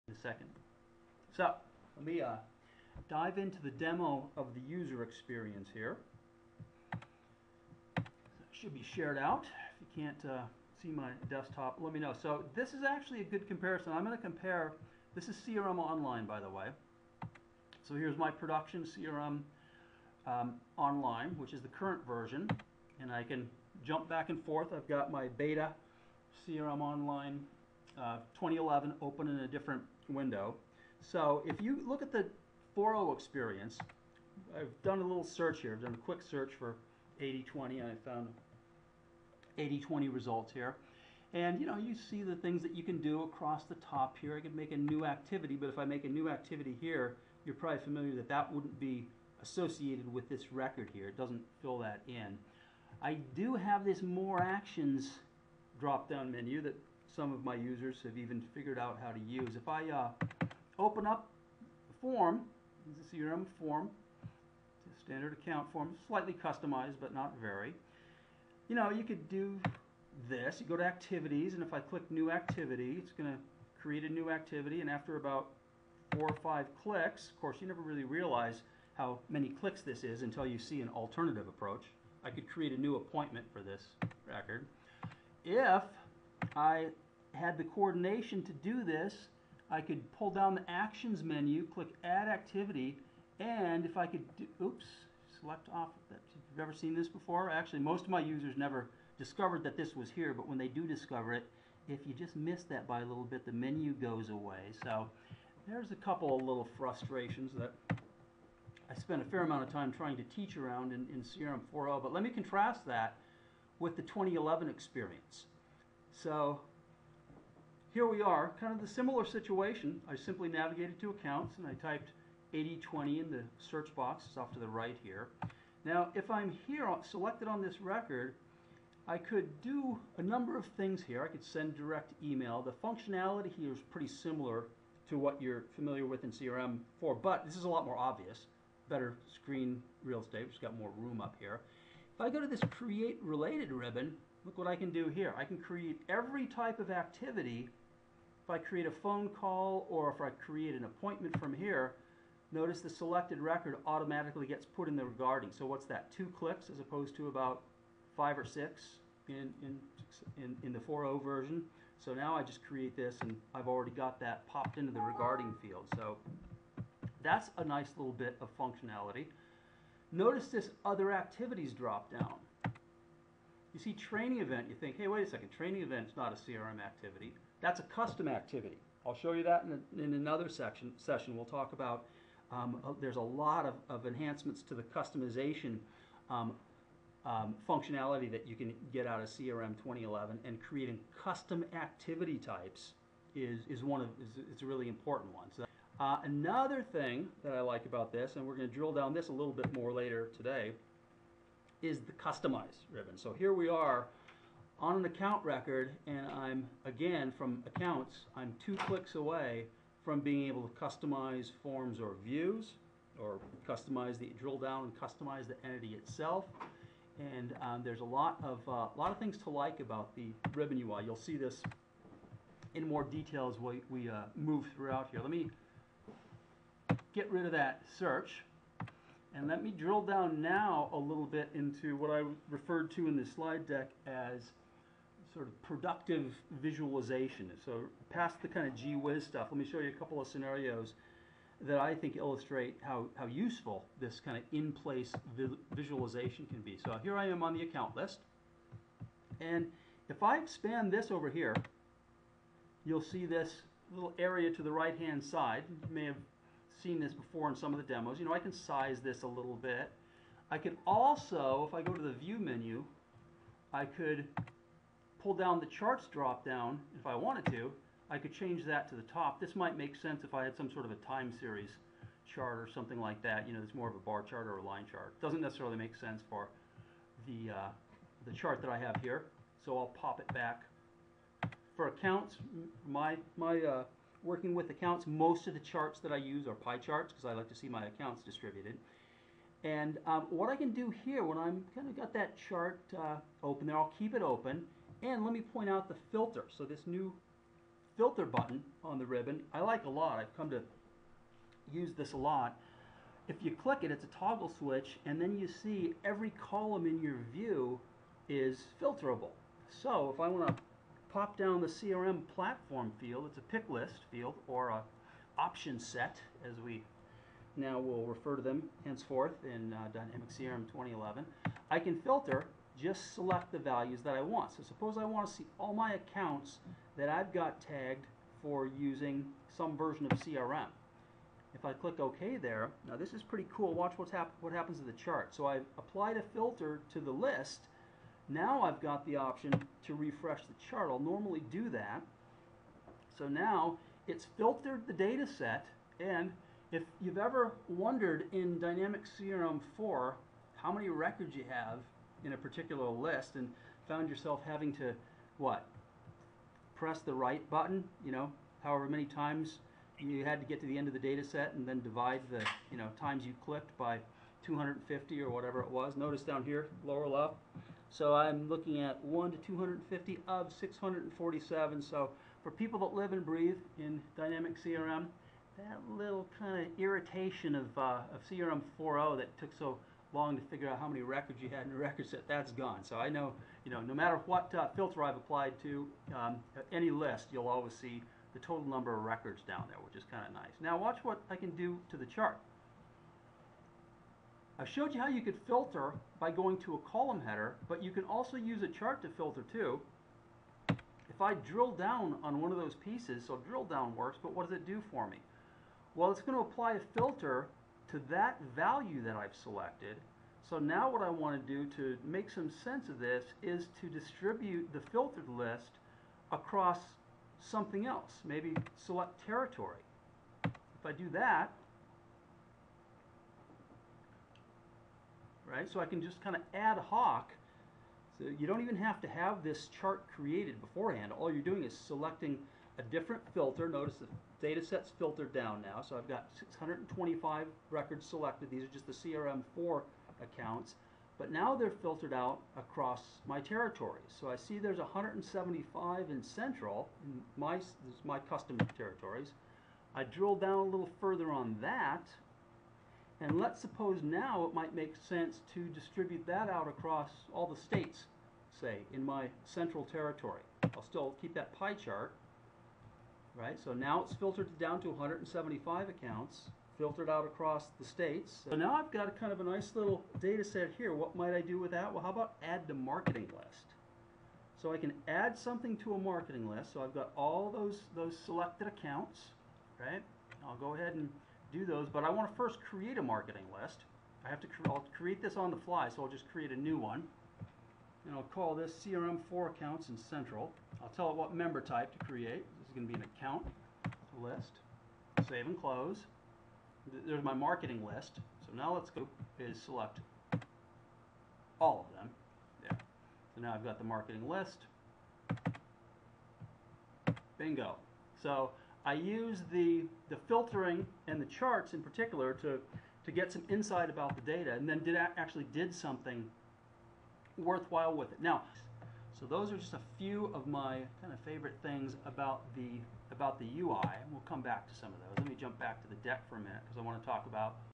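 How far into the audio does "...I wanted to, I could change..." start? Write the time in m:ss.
4:27.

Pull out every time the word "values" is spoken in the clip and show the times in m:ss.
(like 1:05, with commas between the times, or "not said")
5:23, 6:48.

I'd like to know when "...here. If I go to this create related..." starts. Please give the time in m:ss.
2:21.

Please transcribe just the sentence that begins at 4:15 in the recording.
You may have seen this before in some of the demos.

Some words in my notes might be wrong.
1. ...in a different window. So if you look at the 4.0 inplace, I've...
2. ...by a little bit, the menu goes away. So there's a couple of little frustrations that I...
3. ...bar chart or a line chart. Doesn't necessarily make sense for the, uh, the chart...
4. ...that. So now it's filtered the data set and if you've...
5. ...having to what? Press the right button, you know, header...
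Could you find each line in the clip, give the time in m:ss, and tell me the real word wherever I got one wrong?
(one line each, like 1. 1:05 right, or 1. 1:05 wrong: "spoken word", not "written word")
1. 0:29 wrong: "experience", not "inplace"
2. 1:42 right
3. 4:33 right
4. 5:41 right
5. 5:54 wrong: "however", not "header".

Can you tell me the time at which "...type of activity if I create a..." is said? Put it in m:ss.
2:26.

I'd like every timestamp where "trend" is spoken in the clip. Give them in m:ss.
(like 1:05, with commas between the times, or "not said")
not said.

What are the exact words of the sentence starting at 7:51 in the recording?
Well, how about add to marketing list?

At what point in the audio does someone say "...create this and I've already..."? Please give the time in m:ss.
2:42.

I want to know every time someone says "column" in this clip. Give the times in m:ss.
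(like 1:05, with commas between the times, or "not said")
5:06, 6:36.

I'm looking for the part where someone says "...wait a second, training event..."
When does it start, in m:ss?
2:55.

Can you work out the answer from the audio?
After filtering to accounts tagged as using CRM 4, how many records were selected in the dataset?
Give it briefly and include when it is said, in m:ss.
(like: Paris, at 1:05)
625, at 7:16.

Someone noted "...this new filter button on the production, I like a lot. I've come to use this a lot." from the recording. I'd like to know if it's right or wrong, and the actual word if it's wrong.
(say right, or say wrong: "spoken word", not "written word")
wrong: "ribbon", not "production".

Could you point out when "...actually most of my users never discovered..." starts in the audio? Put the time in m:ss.
1:37.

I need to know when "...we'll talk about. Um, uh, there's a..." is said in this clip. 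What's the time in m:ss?
3:01.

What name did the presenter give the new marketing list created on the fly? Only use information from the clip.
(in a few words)
CRM 4 accounts in Central.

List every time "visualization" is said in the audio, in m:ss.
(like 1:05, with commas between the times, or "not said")
3:56, 4:05.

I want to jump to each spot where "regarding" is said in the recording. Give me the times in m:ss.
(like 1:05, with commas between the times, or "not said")
2:35, 2:44.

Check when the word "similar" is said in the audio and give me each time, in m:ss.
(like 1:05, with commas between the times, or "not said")
1:58, 2:14.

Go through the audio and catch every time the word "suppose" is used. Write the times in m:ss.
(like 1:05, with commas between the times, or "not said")
5:24, 7:33.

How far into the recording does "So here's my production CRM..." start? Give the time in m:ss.
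0:17.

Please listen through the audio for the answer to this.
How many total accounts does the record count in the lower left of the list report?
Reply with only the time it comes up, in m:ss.
6:10.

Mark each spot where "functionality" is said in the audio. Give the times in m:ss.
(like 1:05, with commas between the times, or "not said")
2:12, 2:48, 3:07.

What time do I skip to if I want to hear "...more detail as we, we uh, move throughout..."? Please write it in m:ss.
3:42.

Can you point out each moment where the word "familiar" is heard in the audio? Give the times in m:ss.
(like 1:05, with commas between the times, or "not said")
0:47, 2:15.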